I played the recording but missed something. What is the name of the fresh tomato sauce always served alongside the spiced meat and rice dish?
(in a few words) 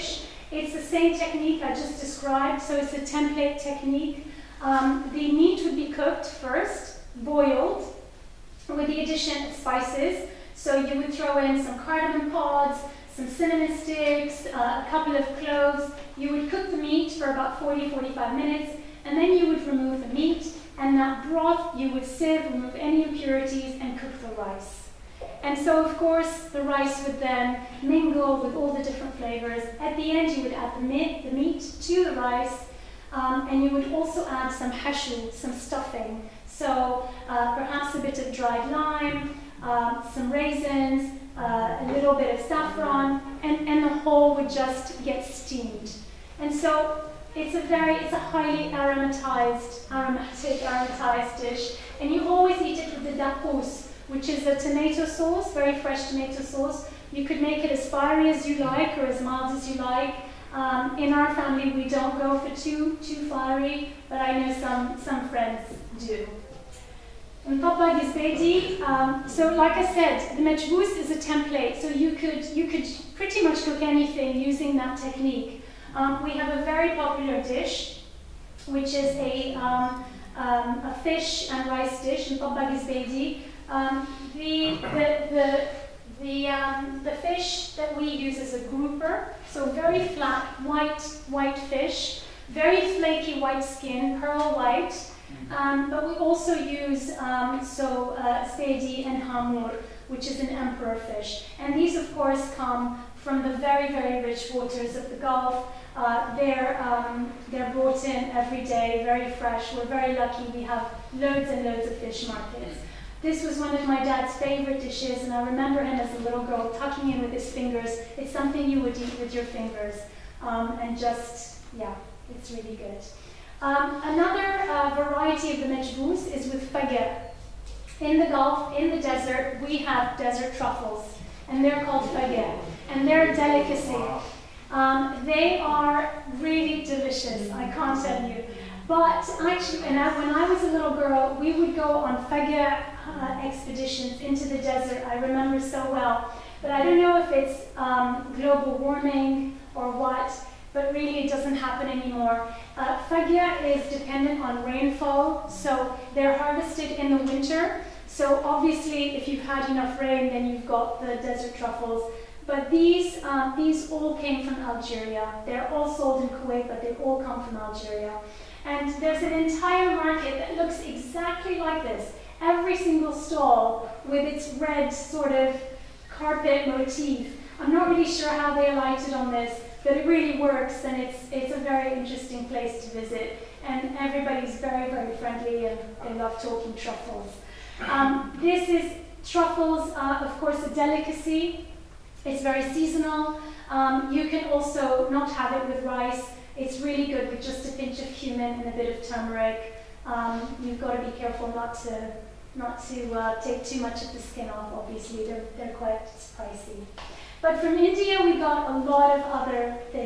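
dapus.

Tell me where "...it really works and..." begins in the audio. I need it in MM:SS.
02:59.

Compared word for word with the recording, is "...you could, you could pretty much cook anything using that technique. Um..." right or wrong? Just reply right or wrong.
right.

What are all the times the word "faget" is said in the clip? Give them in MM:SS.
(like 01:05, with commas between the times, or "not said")
02:06, 02:12.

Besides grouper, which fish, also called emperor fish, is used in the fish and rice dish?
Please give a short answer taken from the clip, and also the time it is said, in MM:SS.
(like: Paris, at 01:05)
hamur, at 01:39.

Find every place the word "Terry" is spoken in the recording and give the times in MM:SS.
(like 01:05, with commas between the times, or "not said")
not said.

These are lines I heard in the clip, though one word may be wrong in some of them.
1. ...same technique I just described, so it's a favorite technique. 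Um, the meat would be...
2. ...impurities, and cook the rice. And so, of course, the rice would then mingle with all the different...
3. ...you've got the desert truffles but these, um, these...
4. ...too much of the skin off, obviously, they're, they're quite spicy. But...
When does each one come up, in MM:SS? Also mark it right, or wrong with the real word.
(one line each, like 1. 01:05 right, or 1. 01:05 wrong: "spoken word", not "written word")
1. 00:00 wrong: "template", not "favorite"
2. 00:23 right
3. 02:40 right
4. 03:23 right.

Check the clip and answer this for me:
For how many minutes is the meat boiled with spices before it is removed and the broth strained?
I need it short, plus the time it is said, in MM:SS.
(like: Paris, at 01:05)
40 to 45 minutes, at 00:17.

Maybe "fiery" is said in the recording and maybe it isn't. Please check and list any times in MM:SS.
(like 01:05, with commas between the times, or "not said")
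00:57, 01:03.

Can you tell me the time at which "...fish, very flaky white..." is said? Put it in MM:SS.
01:31.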